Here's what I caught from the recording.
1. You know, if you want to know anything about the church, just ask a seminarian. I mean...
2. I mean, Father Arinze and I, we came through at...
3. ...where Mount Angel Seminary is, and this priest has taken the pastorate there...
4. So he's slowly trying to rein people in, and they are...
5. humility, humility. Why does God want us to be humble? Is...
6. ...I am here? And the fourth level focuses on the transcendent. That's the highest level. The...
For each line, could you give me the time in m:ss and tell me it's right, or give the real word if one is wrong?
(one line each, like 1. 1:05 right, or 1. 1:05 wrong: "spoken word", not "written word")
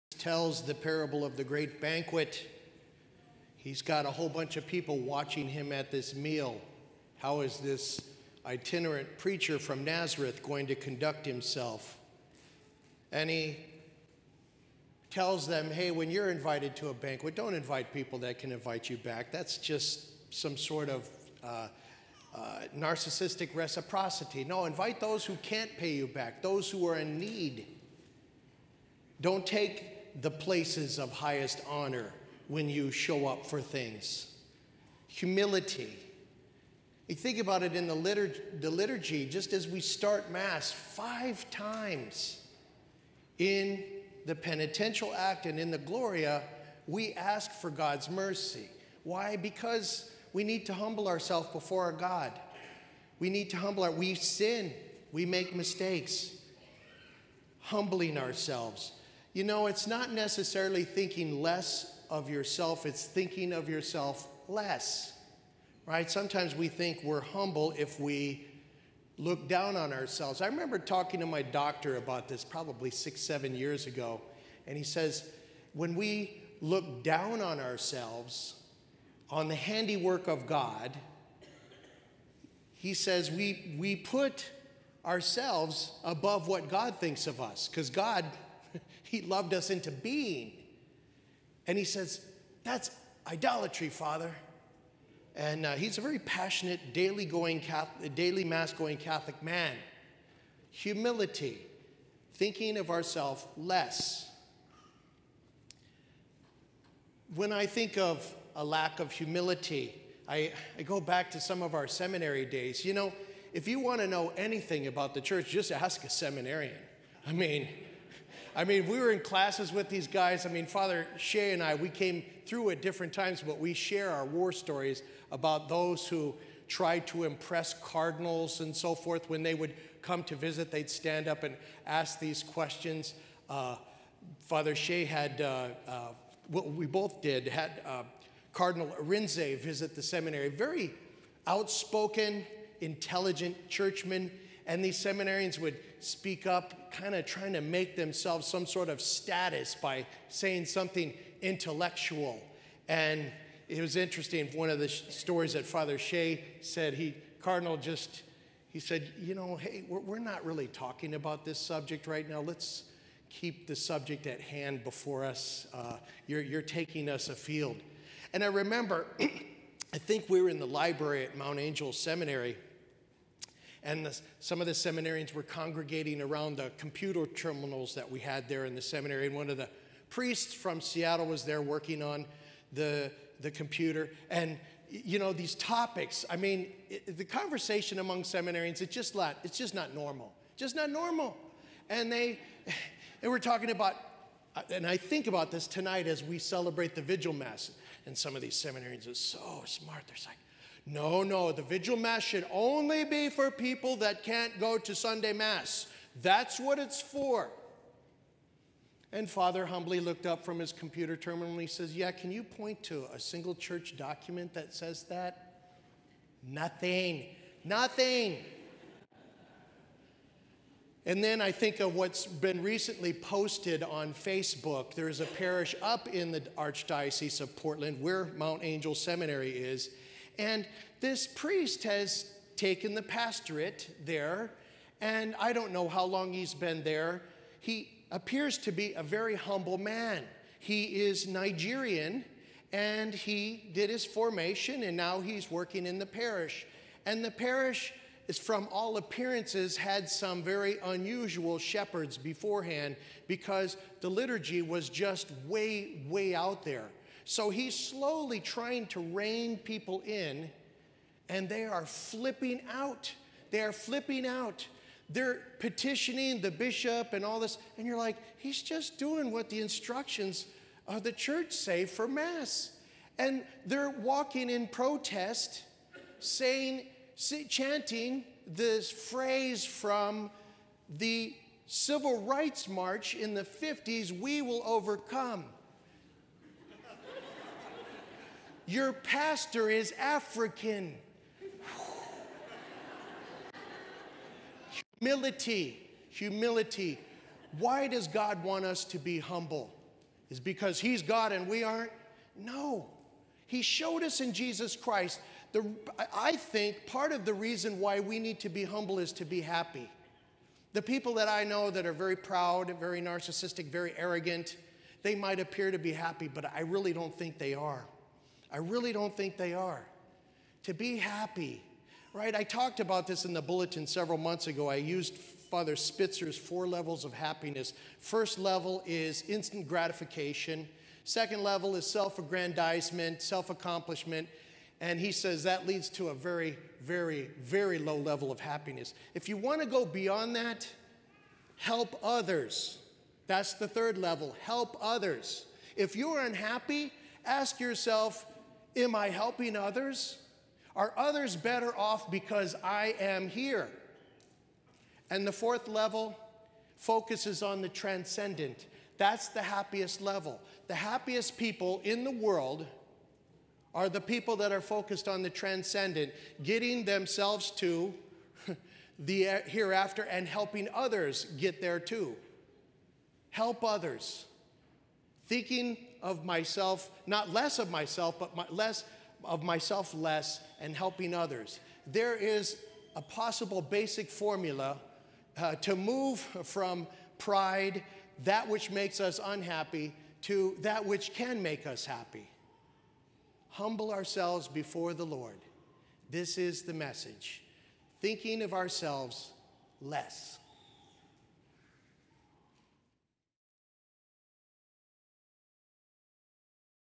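1. 1:52 right
2. 2:00 wrong: "Shea", not "Arinze"
3. 3:48 right
4. 4:17 right
5. 4:54 right
6. 5:52 wrong: "happiest", not "highest".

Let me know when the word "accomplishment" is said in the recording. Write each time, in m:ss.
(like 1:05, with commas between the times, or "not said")
5:33.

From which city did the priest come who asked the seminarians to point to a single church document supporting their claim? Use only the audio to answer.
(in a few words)
Seattle.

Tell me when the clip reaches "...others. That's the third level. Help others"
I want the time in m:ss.
5:42.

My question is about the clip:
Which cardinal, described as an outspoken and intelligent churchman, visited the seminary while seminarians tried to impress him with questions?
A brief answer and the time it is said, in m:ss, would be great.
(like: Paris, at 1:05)
Cardinal Arinze, at 2:18.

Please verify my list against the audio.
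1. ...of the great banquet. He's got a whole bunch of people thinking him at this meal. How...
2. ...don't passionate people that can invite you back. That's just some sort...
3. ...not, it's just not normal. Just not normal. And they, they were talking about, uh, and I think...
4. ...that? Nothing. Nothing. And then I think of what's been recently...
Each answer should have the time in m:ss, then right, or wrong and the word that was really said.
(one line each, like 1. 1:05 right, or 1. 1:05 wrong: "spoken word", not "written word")
1. 0:01 wrong: "watching", not "thinking"
2. 0:17 wrong: "invite", not "passionate"
3. 3:09 right
4. 3:35 right.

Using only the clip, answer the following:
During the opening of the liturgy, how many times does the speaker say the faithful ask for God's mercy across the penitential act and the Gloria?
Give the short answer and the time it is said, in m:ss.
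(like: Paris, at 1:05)
5, at 0:40.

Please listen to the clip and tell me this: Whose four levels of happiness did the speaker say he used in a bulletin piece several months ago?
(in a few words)
Father Spitzer.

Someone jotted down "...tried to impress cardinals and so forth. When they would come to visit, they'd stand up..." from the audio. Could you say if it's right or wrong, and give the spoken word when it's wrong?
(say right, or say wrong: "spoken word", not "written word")
right.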